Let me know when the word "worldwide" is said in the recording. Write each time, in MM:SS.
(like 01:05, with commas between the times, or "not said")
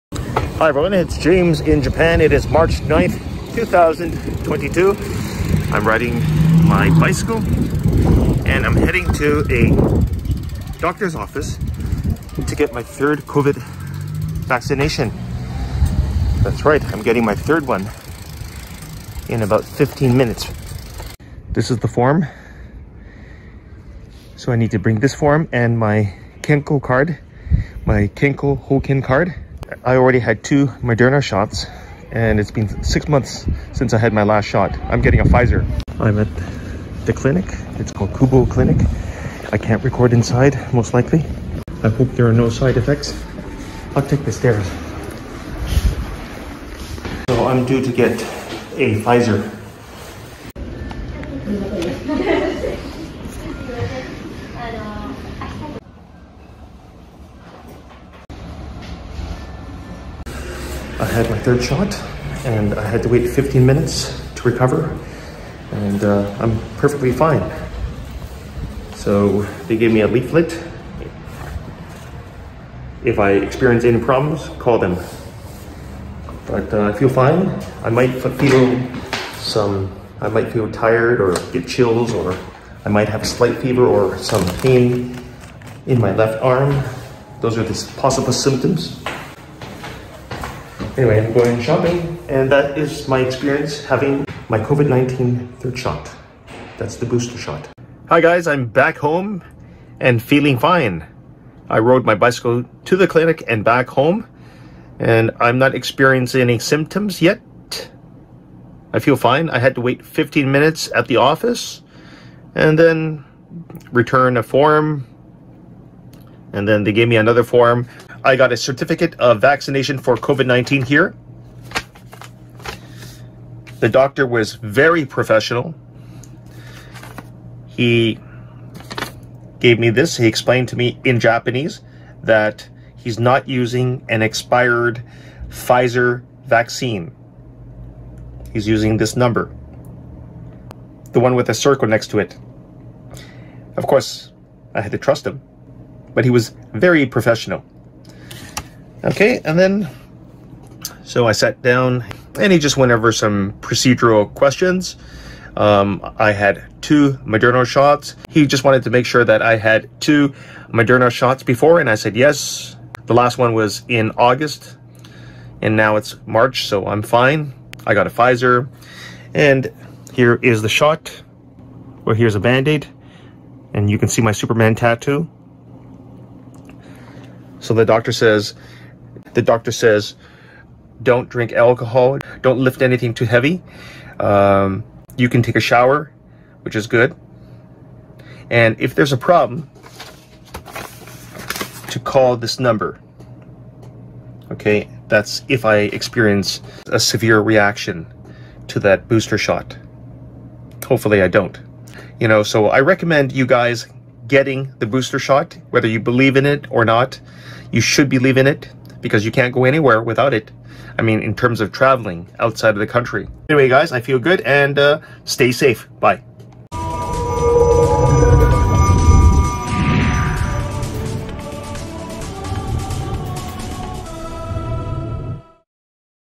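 not said.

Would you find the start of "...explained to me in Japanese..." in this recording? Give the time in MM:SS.
02:10.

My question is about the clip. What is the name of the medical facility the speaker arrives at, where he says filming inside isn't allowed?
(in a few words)
Kubo Clinic.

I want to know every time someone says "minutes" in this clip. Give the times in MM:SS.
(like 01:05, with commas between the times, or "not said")
00:20, 01:03, 01:50.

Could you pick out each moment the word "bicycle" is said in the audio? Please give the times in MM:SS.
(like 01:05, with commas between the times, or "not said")
00:06, 01:42.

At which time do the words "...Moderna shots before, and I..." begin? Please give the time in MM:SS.
02:40.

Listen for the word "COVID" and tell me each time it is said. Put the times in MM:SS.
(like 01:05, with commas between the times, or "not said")
00:13, 01:34, 02:00.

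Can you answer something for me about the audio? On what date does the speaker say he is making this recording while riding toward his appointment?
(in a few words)
March 9, 2022.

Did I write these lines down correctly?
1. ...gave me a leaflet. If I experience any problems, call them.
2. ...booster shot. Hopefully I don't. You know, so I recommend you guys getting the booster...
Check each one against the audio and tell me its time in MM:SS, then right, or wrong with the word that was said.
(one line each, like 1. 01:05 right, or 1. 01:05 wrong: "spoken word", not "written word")
1. 01:09 right
2. 03:19 right.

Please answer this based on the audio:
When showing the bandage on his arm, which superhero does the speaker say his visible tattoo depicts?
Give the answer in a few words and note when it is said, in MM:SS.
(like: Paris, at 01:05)
Superman, at 02:54.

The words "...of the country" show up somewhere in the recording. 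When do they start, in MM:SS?
03:32.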